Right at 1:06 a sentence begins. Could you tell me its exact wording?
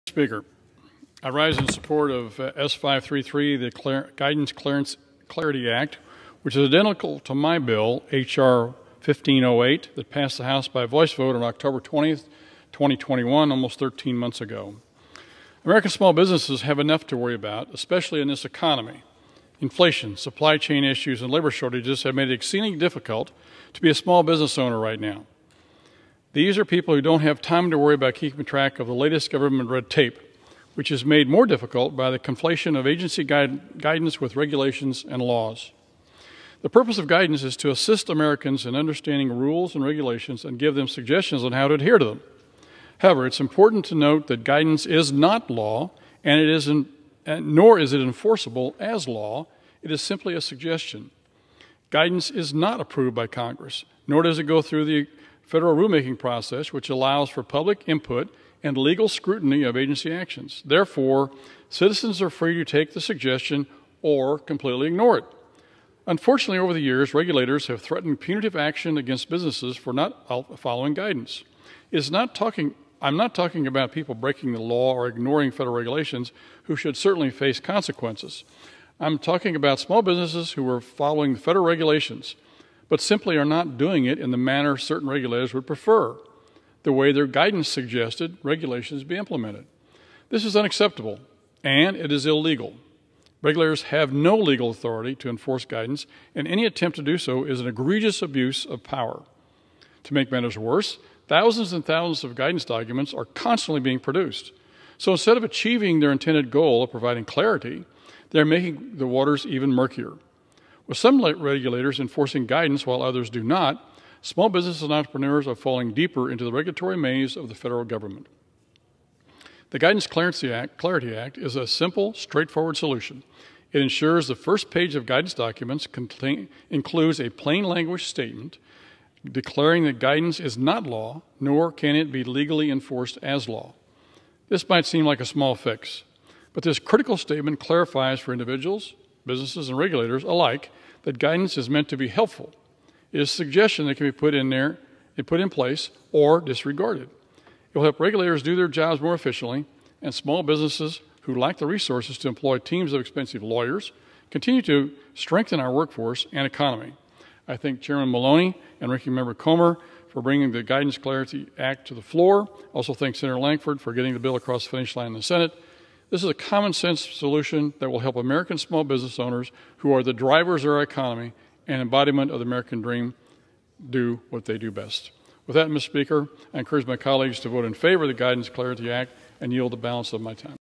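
Unfortunately, over the years, regulators have threatened punitive action against businesses for not following guidance.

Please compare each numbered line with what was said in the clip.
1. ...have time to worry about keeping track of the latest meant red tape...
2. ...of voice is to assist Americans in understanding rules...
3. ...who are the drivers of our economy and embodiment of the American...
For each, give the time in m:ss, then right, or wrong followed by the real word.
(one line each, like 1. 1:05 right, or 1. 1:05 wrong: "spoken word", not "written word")
1. 0:27 wrong: "government", not "meant"
2. 0:36 wrong: "guidance", not "voice"
3. 2:49 right.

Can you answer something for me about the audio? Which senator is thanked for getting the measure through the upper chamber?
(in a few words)
Senator Lankford.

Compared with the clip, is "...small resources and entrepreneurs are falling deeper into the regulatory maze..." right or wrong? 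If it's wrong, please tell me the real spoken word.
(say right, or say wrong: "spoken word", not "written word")
wrong: "businesses", not "resources".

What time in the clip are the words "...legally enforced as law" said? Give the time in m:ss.
2:12.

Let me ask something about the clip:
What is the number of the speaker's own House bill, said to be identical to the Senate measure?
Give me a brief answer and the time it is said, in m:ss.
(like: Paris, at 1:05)
H.R. 1508, at 0:08.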